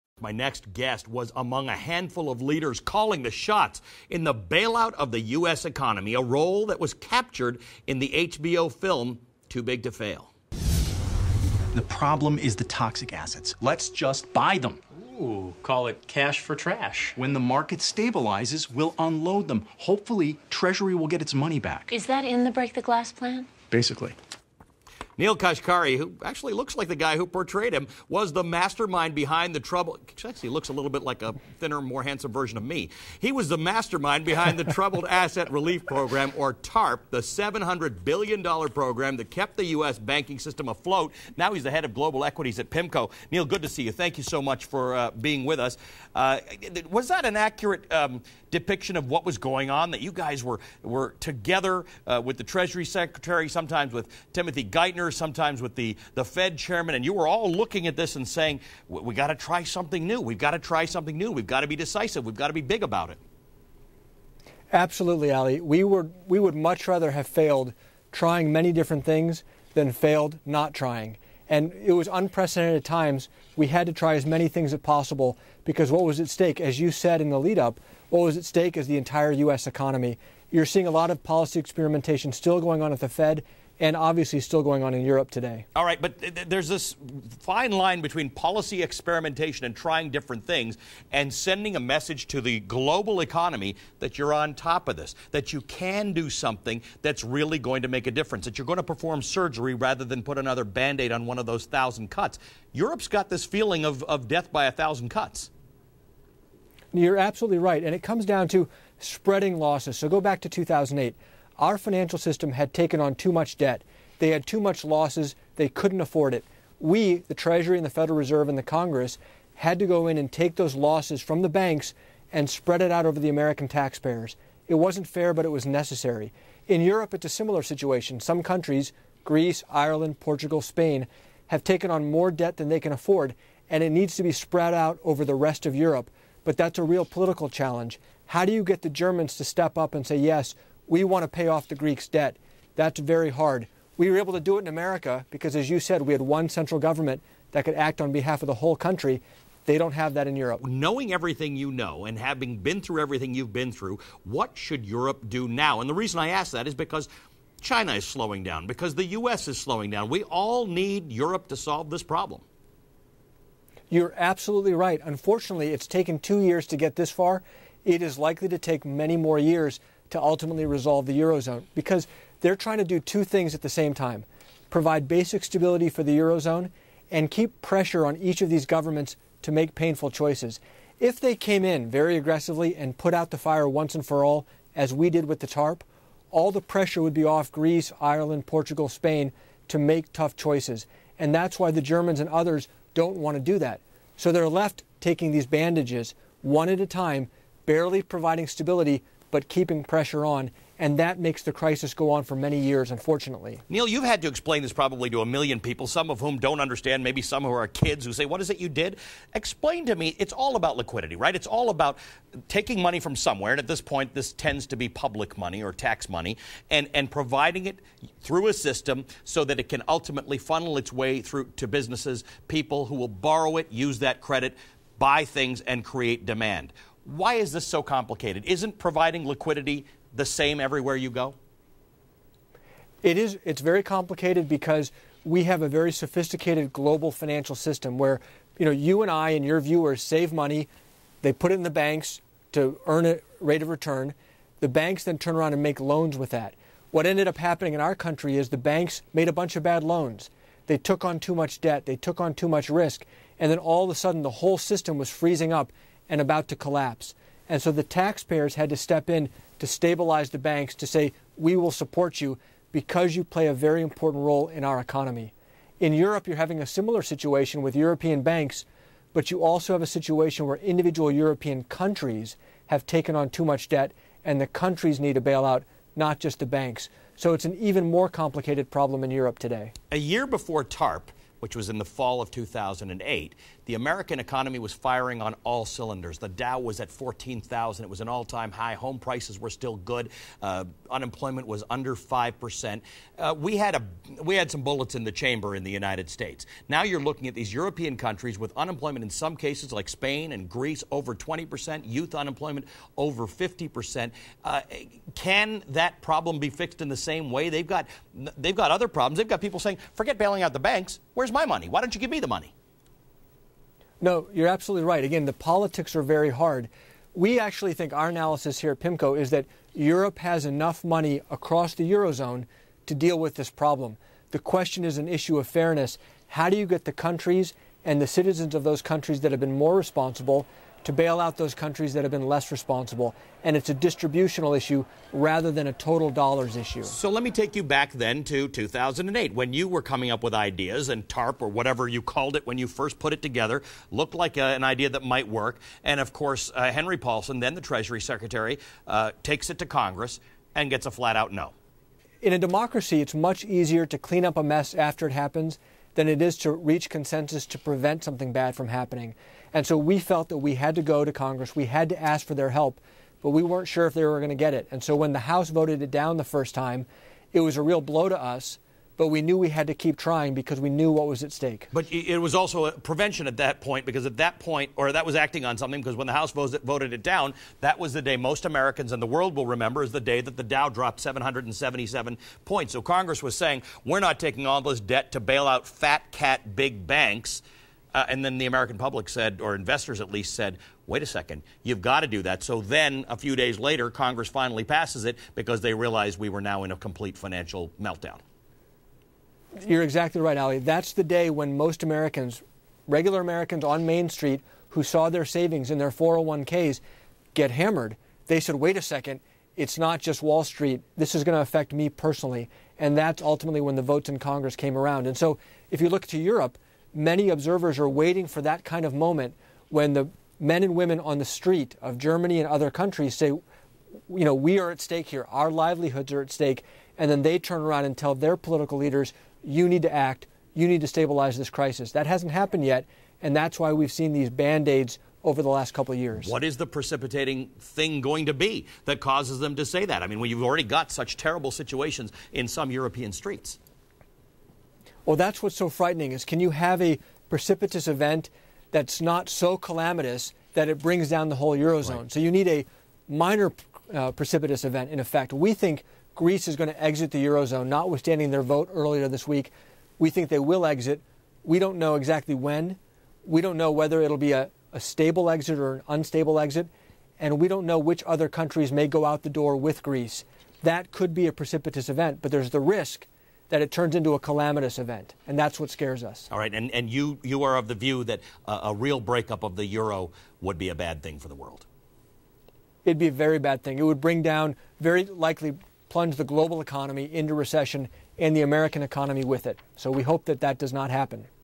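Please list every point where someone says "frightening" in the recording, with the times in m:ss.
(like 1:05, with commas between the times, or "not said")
7:25.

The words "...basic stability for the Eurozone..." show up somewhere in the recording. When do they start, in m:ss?
2:55.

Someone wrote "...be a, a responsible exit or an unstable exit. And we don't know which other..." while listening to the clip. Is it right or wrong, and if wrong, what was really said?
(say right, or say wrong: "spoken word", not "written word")
wrong: "stable", not "responsible".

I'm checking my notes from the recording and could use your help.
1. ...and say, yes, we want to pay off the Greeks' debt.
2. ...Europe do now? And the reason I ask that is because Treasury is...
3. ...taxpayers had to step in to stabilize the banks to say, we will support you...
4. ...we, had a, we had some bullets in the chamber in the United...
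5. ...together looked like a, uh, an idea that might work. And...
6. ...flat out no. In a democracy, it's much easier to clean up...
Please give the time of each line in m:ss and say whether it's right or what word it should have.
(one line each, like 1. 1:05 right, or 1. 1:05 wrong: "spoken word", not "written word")
1. 2:19 right
2. 2:34 wrong: "China", not "Treasury"
3. 4:17 right
4. 4:53 right
5. 5:43 right
6. 5:50 right.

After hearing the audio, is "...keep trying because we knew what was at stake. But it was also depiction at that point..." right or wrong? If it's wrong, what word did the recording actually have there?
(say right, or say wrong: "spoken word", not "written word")
wrong: "prevention", not "depiction".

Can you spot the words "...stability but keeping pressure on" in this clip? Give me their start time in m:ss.
3:18.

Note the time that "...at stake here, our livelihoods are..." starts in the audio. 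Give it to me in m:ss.
7:04.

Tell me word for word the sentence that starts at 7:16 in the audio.
What is the precipitating thing going to be that causes them to say that?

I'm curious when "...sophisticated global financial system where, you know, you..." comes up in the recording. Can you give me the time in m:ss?
3:55.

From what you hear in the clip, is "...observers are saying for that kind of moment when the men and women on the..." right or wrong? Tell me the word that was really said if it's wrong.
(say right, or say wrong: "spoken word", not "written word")
wrong: "waiting", not "saying".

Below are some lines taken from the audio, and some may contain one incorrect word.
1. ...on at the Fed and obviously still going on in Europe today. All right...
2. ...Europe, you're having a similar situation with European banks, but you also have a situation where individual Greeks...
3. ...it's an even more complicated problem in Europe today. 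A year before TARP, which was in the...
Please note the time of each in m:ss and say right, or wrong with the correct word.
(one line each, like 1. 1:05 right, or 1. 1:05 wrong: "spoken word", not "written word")
1. 1:22 right
2. 4:25 wrong: "European", not "Greeks"
3. 4:37 right.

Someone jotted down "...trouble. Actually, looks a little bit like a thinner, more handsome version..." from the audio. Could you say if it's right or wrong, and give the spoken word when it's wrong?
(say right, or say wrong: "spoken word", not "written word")
right.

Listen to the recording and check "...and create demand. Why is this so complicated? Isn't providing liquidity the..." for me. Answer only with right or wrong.
right.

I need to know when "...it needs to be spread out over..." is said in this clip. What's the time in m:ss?
2:13.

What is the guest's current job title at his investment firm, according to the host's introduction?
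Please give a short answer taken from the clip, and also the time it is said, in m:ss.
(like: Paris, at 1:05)
head of global equities, at 0:41.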